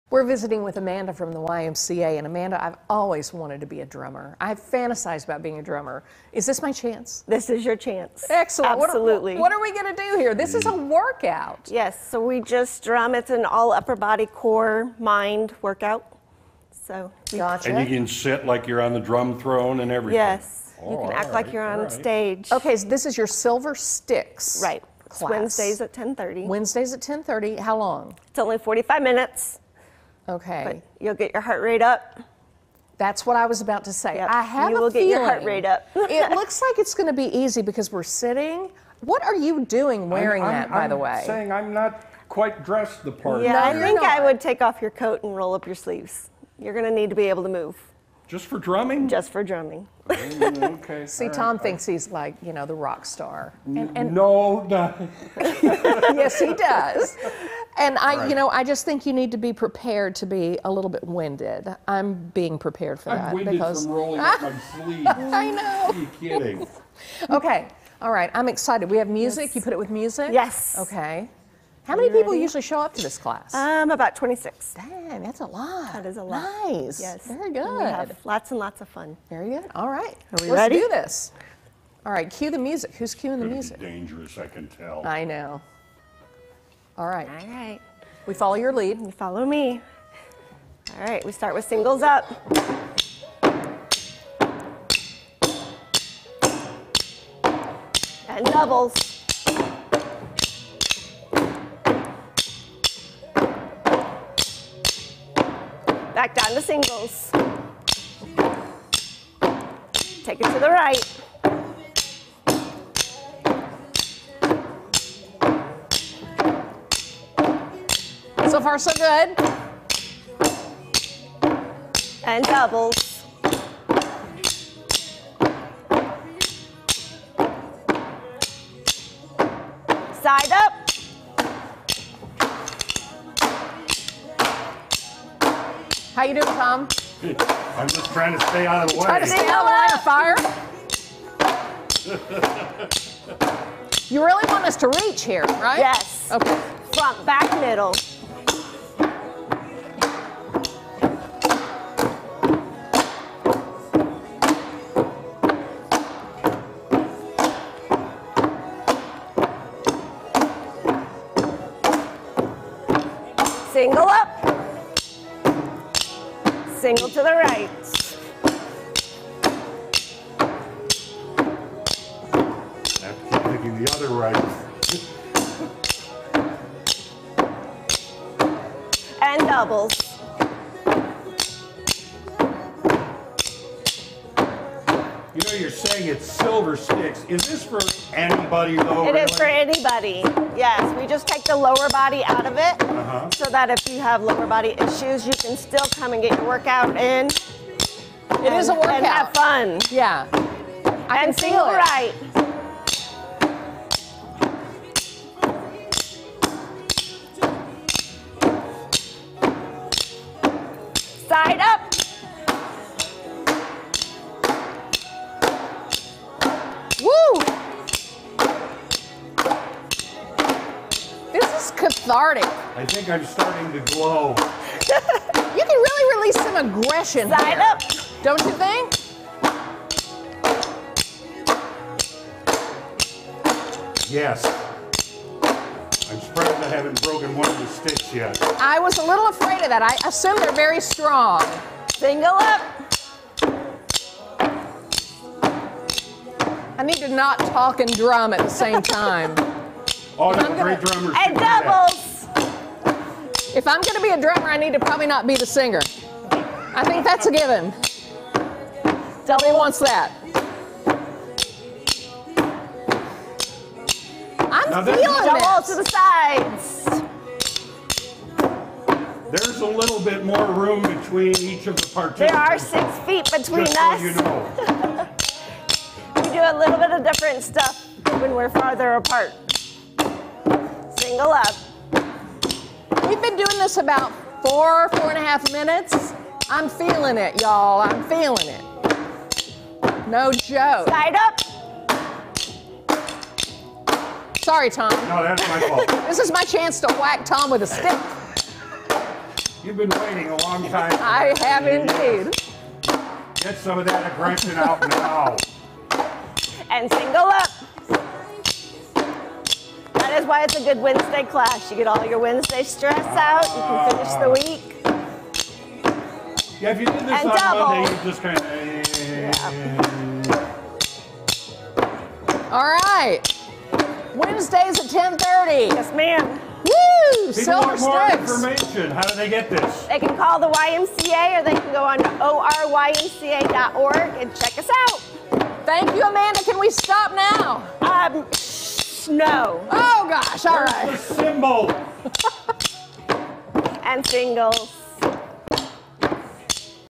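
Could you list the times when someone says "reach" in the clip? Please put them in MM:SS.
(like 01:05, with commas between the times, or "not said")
02:25.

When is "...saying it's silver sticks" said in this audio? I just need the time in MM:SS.
03:05.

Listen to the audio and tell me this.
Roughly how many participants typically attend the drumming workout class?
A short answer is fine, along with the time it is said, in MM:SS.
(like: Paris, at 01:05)
26, at 01:13.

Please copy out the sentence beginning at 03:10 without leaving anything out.
Yes, we just take the lower body out of it uh -huh.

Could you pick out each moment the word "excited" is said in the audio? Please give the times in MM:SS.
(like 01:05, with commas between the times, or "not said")
01:08.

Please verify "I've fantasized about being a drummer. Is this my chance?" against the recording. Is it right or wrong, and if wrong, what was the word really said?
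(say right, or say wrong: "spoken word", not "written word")
right.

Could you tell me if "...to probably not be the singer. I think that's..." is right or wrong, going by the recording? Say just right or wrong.
right.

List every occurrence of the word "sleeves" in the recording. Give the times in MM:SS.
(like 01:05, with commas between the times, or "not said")
00:45, 01:04.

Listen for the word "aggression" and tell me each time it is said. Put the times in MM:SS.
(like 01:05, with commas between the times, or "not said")
03:46, 05:04.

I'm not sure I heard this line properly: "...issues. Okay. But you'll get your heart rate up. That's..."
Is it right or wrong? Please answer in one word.
wrong.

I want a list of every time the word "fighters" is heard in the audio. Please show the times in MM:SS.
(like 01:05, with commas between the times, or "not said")
not said.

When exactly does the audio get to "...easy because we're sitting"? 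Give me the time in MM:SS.
00:37.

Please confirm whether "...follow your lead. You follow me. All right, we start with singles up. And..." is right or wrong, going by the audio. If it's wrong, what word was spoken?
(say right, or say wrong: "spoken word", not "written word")
right.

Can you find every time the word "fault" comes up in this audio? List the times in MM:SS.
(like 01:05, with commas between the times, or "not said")
04:55.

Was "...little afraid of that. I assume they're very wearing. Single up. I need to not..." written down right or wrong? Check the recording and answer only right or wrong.
wrong.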